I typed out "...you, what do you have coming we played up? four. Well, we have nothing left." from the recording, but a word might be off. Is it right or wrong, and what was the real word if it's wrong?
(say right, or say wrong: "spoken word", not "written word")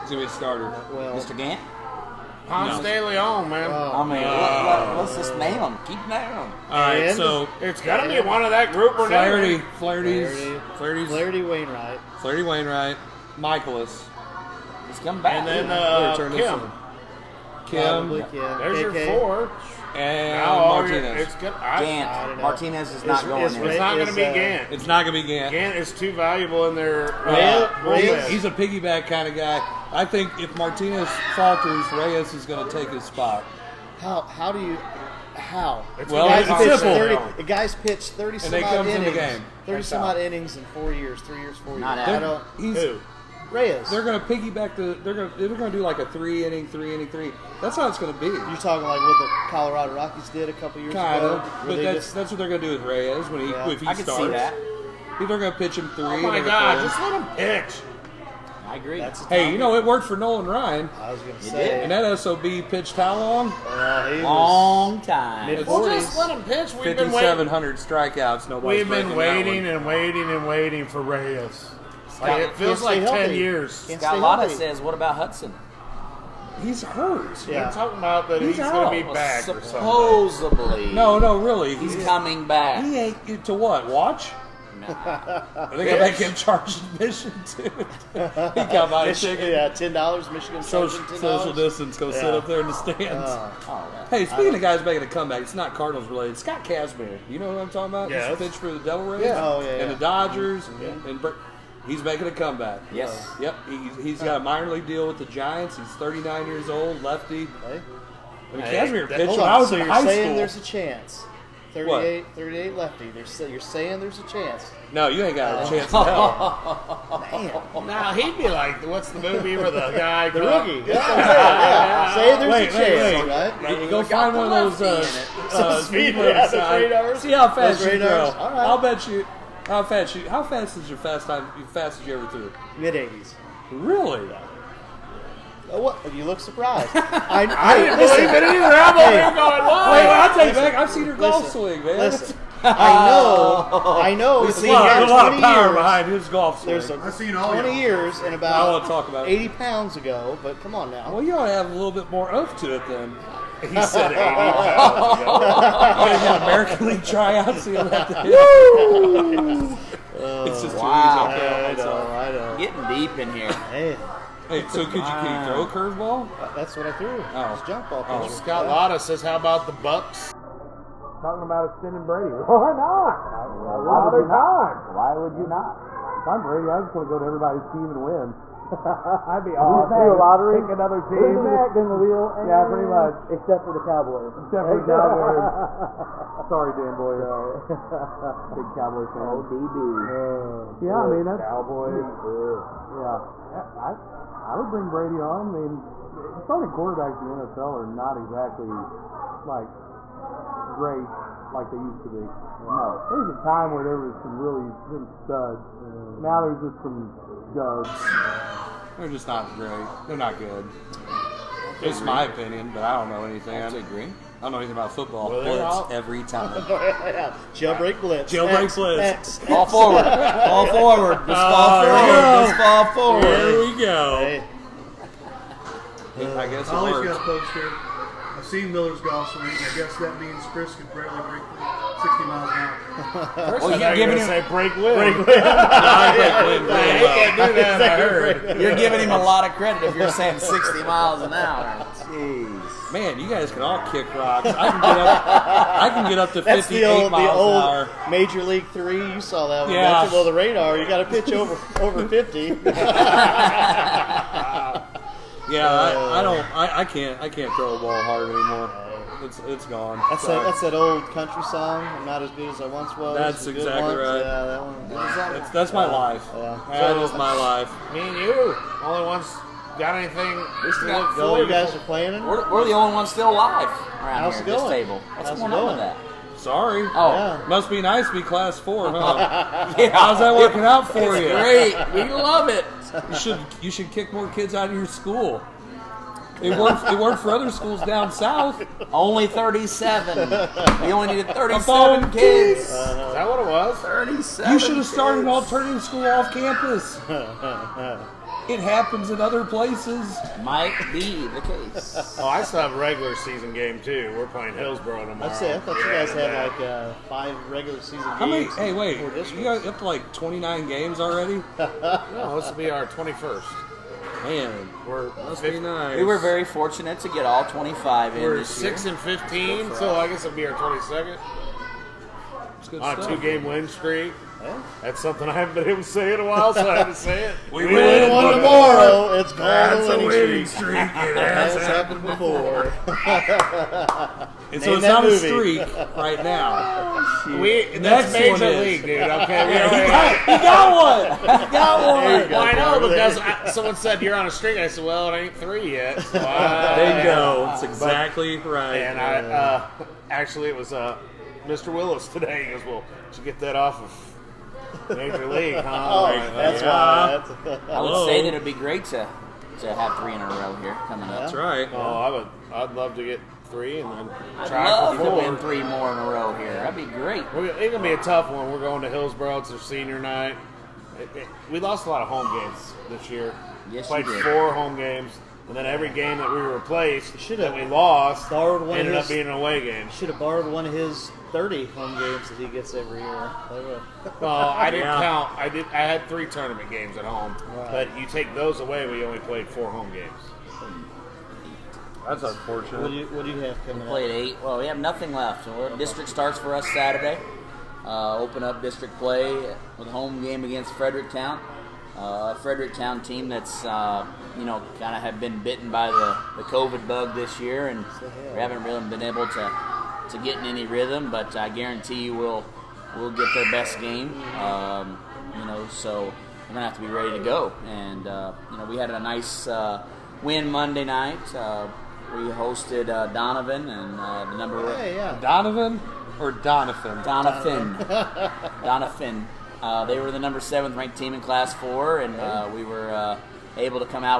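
wrong: "eight", not "four".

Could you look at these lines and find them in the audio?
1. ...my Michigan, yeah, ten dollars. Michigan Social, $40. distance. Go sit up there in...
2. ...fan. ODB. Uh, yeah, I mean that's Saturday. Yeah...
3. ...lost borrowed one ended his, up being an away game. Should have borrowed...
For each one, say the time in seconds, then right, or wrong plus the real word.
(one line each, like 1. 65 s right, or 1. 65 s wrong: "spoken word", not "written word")
1. 88 s wrong: "10", not "40"
2. 189 s wrong: "Cowboys", not "Saturday"
3. 377 s right.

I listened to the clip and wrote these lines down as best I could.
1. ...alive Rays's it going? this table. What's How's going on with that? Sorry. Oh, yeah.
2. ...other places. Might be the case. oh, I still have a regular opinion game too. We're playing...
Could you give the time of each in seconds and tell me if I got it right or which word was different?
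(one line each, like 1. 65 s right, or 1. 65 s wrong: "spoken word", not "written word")
1. 273 s wrong: "How", not "Rays"
2. 299 s wrong: "season", not "opinion".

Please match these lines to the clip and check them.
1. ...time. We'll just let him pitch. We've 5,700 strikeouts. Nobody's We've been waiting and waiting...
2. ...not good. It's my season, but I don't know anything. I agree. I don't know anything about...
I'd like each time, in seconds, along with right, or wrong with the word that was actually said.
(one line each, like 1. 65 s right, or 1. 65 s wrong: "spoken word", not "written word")
1. 65 s right
2. 210 s wrong: "opinion", not "season".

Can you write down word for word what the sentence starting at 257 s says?
I can't throw a ball hard anymore.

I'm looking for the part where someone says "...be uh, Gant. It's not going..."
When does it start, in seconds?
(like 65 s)
24 s.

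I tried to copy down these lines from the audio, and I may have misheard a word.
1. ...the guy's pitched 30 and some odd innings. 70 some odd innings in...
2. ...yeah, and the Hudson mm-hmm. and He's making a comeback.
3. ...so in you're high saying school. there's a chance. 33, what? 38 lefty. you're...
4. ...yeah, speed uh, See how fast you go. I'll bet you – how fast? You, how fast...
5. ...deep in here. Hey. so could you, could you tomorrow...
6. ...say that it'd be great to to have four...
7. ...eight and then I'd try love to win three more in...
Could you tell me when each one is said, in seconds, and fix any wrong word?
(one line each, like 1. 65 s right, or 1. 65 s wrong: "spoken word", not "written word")
1. 37 s wrong: "30", not "70"
2. 99 s wrong: "Dodgers", not "Hudson"
3. 109 s wrong: "38", not "33"
4. 126 s right
5. 163 s wrong: "throw", not "tomorrow"
6. 358 s wrong: "three", not "four"
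7. 363 s wrong: "three", not "eight".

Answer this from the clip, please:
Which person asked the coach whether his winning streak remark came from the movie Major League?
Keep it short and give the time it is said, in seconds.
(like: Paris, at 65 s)
Mr. Willis, at 351 s.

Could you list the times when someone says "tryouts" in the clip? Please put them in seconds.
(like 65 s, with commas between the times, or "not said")
157 s.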